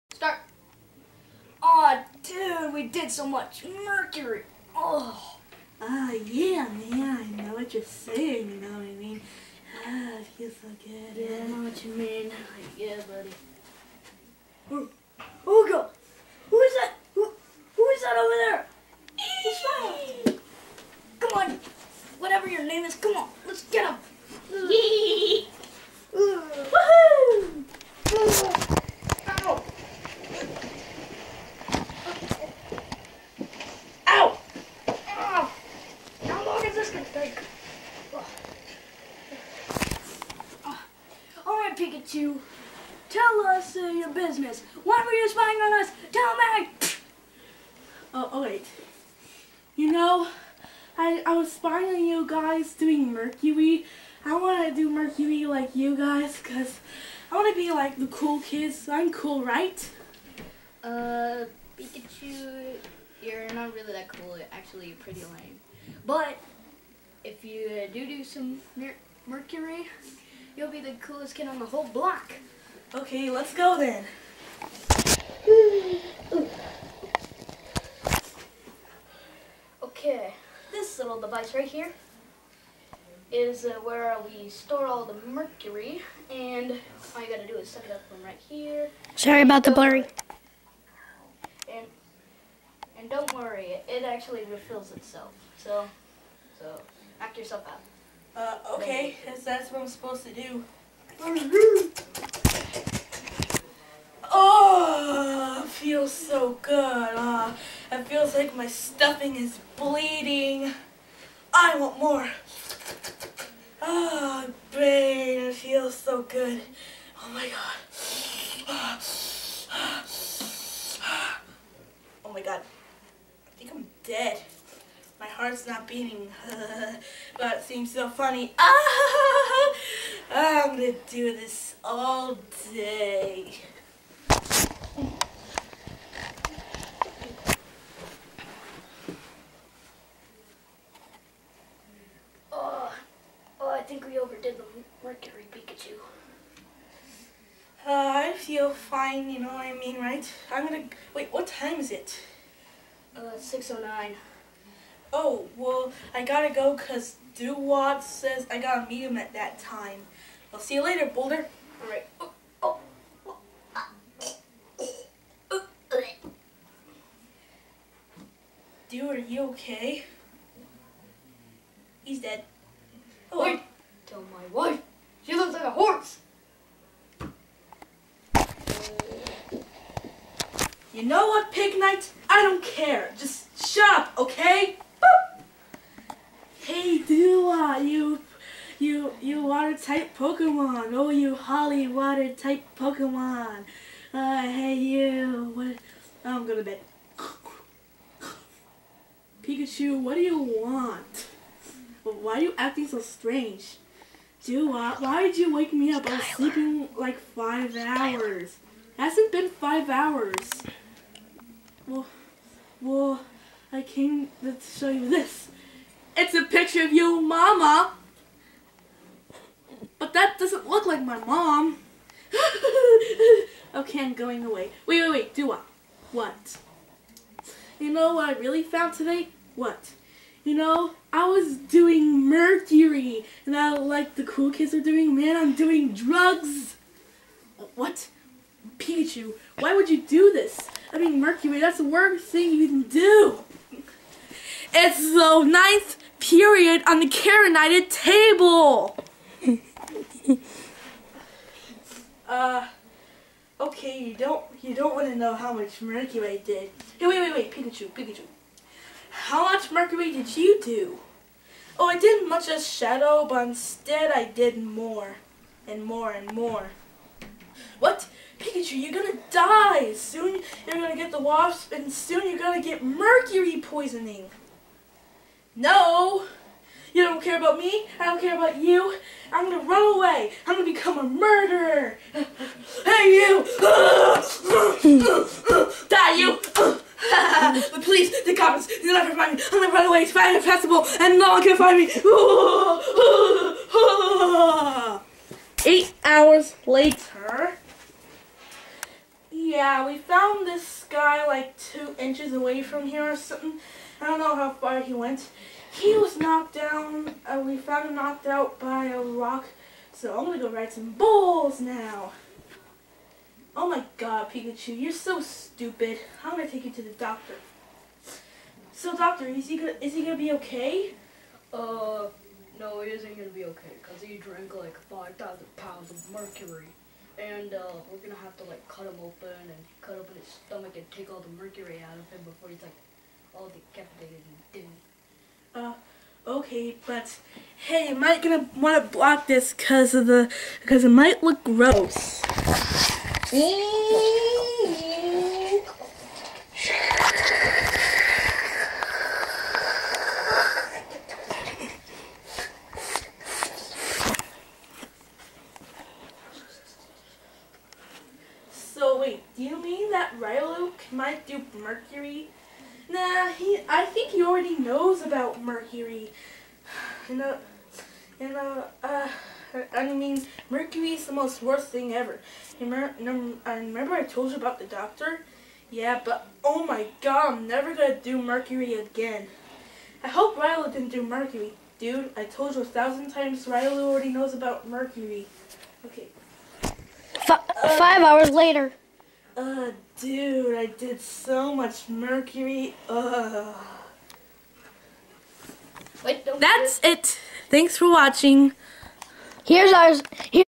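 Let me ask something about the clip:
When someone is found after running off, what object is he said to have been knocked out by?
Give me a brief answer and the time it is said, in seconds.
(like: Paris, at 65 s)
A rock, at 308 s.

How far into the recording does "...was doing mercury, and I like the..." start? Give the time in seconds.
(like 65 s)
231 s.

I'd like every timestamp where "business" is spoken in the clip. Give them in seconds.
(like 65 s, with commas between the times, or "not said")
44 s.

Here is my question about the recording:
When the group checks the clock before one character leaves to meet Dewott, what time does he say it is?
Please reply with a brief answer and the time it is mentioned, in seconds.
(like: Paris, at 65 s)
6:09, at 153 s.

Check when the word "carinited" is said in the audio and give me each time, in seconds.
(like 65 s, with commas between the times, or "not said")
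247 s.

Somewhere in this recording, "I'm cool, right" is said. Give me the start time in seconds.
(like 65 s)
58 s.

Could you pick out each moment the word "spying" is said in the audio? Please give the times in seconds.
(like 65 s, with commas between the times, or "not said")
45 s, 51 s.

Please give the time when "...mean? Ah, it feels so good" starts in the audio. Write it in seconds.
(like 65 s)
8 s.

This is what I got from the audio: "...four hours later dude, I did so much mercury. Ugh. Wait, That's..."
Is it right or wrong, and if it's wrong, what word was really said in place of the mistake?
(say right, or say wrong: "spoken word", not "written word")
wrong: "five", not "four".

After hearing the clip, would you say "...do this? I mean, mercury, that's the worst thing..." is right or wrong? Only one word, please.
right.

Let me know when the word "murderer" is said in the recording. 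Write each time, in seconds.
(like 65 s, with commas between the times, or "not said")
281 s.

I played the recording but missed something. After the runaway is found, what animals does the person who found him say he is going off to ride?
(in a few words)
Bulls.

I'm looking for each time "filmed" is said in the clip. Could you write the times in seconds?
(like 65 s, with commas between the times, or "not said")
not said.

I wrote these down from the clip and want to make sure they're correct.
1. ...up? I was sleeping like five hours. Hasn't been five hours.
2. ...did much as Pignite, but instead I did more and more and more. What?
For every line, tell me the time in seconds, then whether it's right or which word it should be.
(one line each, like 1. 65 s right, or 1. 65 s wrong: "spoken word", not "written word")
1. 205 s right
2. 261 s wrong: "Shadow", not "Pignite".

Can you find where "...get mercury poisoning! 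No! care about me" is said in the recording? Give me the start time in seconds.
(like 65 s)
272 s.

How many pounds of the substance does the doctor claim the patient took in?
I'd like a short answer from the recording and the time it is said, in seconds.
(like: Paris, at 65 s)
5,000, at 324 s.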